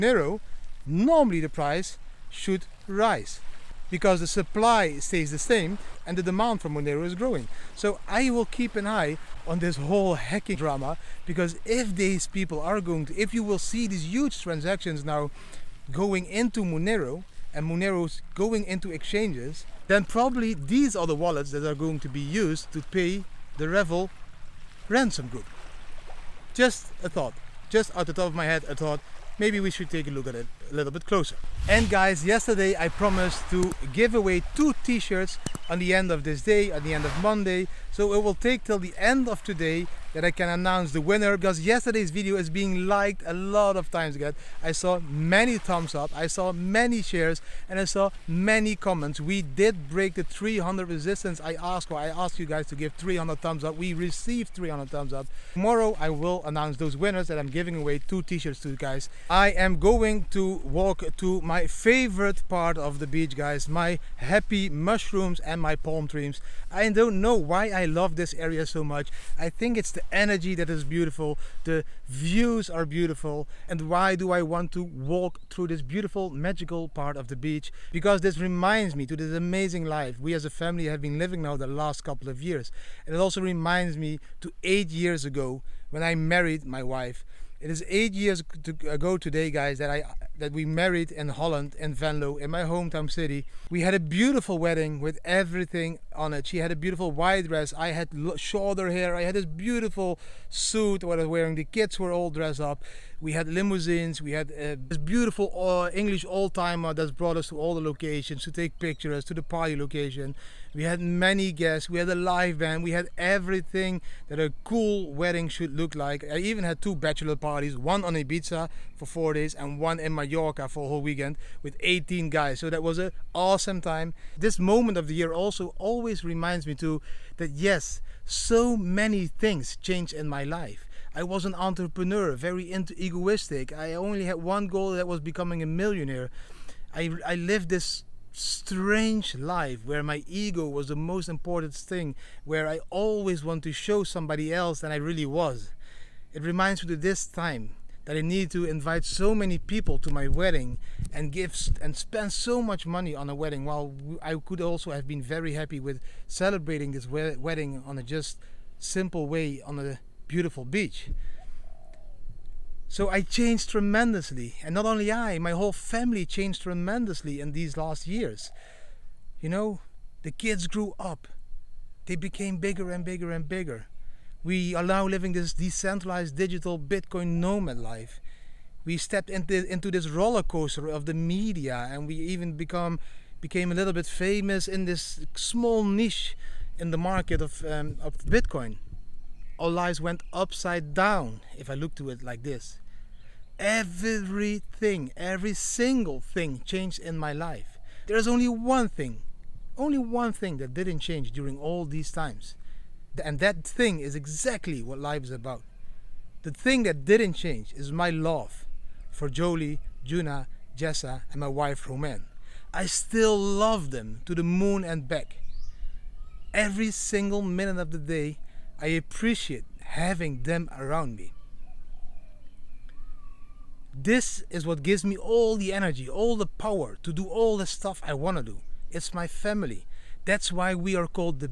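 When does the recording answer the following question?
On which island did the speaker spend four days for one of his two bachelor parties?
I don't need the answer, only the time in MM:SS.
01:58.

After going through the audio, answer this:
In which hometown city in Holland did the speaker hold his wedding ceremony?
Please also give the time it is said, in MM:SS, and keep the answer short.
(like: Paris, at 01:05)
Venlo, at 01:31.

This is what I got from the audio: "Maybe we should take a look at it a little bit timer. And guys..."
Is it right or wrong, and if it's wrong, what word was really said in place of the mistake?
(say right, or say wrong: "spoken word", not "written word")
wrong: "closer", not "timer".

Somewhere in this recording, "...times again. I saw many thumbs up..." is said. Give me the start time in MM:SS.
00:43.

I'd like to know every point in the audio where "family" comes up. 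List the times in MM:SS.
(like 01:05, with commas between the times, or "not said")
01:20, 02:45, 03:49.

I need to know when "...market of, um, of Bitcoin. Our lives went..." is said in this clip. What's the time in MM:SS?
03:06.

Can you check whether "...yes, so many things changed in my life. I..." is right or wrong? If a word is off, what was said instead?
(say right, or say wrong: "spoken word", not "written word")
right.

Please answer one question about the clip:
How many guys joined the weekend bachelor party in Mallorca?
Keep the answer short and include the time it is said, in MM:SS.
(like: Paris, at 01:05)
18, at 02:01.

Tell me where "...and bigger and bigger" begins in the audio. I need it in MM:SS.
02:52.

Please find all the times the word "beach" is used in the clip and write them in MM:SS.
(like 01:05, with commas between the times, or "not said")
01:03, 01:17, 02:40.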